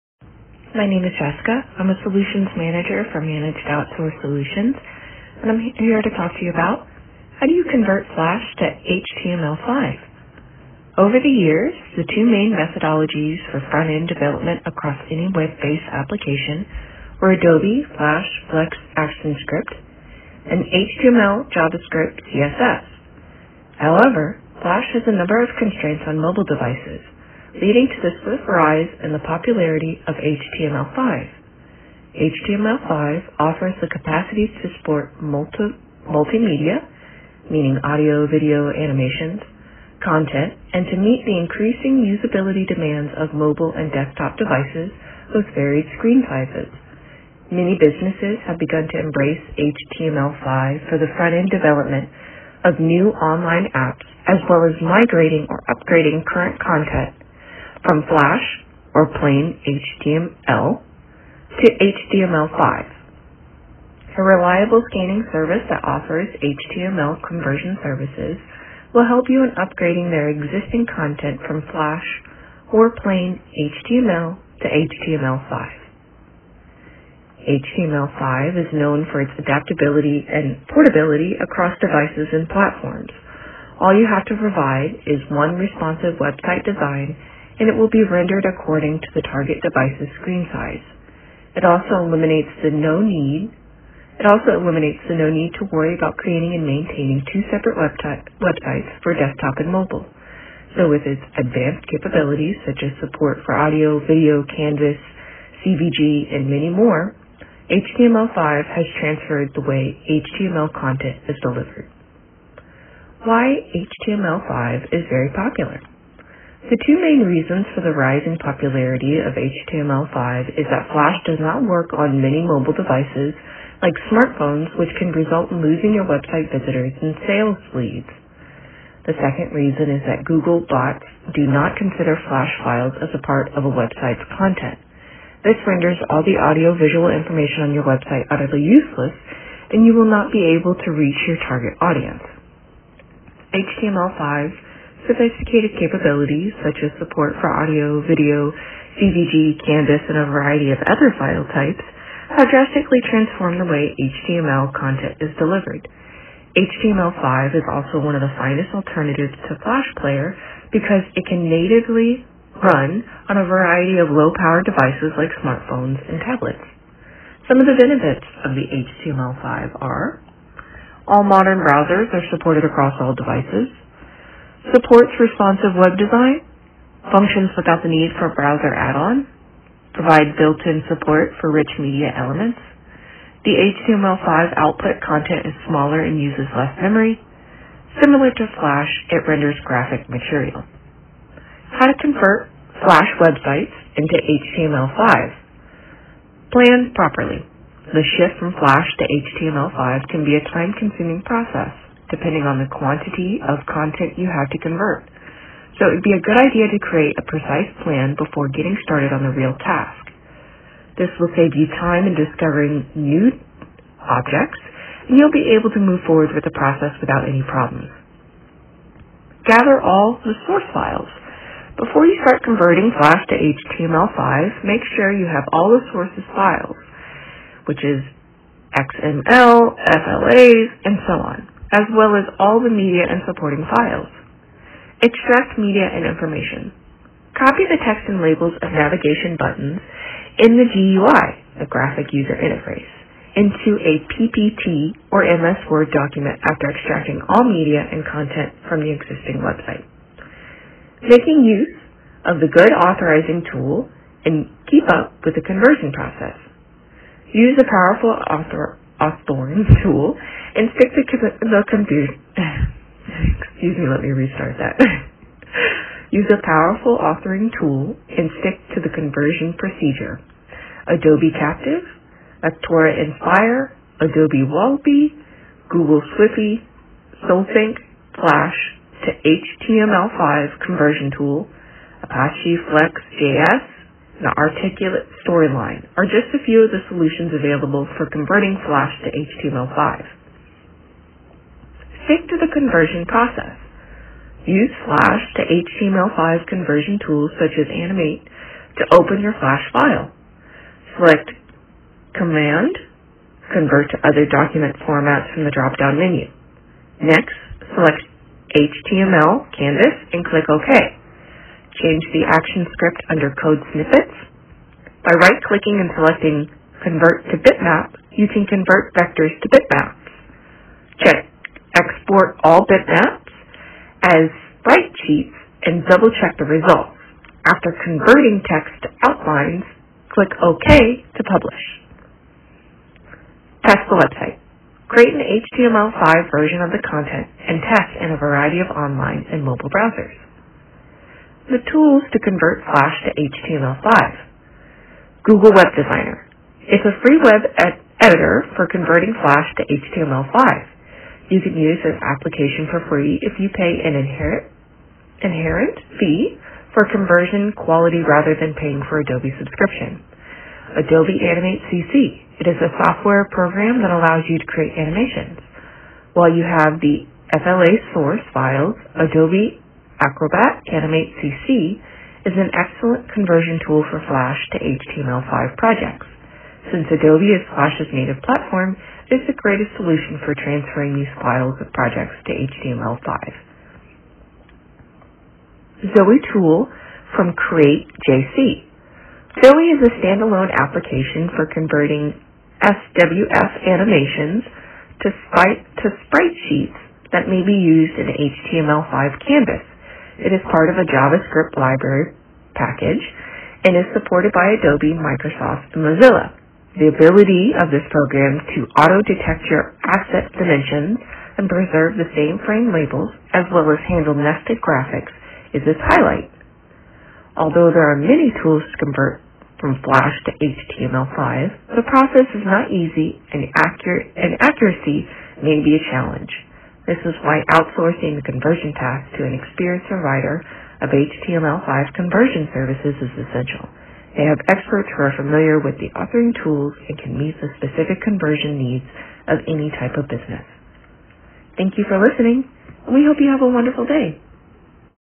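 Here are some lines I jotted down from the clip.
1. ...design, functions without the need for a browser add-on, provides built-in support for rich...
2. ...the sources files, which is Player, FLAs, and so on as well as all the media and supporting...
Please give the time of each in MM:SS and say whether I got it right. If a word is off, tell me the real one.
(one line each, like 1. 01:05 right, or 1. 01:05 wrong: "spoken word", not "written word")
1. 02:55 right
2. 03:45 wrong: "XML", not "Player".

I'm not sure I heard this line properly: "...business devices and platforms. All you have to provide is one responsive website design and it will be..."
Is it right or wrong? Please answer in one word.
wrong.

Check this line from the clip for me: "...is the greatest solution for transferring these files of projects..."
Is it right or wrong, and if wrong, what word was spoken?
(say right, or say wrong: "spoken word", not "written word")
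right.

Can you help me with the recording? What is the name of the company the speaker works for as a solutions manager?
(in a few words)
Managed Outsource Solutions.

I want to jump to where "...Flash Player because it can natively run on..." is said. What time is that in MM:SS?
02:39.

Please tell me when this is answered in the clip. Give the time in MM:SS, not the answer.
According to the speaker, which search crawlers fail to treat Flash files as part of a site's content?
02:10.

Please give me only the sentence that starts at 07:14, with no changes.
They have experts who are familiar with the authoring tools and can meet the specific conversion needs of any type of business.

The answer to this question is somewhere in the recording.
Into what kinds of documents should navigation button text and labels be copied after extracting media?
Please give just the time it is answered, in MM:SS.
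04:04.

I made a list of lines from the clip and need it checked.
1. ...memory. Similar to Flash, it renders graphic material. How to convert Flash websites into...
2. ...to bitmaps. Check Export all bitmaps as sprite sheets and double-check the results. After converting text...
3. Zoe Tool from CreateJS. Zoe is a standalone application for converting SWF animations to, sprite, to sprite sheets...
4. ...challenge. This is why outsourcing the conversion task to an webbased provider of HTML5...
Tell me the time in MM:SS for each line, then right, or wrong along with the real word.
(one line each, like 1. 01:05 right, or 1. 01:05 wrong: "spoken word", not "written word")
1. 03:06 right
2. 05:19 right
3. 06:25 right
4. 07:05 wrong: "experienced", not "webbased".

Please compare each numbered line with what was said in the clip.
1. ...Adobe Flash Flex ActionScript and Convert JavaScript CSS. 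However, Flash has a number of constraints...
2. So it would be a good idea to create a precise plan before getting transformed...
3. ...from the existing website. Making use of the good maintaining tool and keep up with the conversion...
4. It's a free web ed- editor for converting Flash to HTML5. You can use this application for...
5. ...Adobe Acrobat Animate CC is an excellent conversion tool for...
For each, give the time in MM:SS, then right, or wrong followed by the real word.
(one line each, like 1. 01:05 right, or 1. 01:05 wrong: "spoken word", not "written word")
1. 00:17 wrong: "HTML", not "Convert"
2. 03:25 wrong: "started", not "transformed"
3. 04:08 wrong: "authorizing", not "maintaining"
4. 05:46 right
5. 06:08 right.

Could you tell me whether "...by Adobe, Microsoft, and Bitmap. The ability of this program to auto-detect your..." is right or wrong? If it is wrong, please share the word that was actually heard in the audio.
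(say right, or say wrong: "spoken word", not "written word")
wrong: "Mozilla", not "Bitmap".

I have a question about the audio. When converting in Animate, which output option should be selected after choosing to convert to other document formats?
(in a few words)
HTML Canvas.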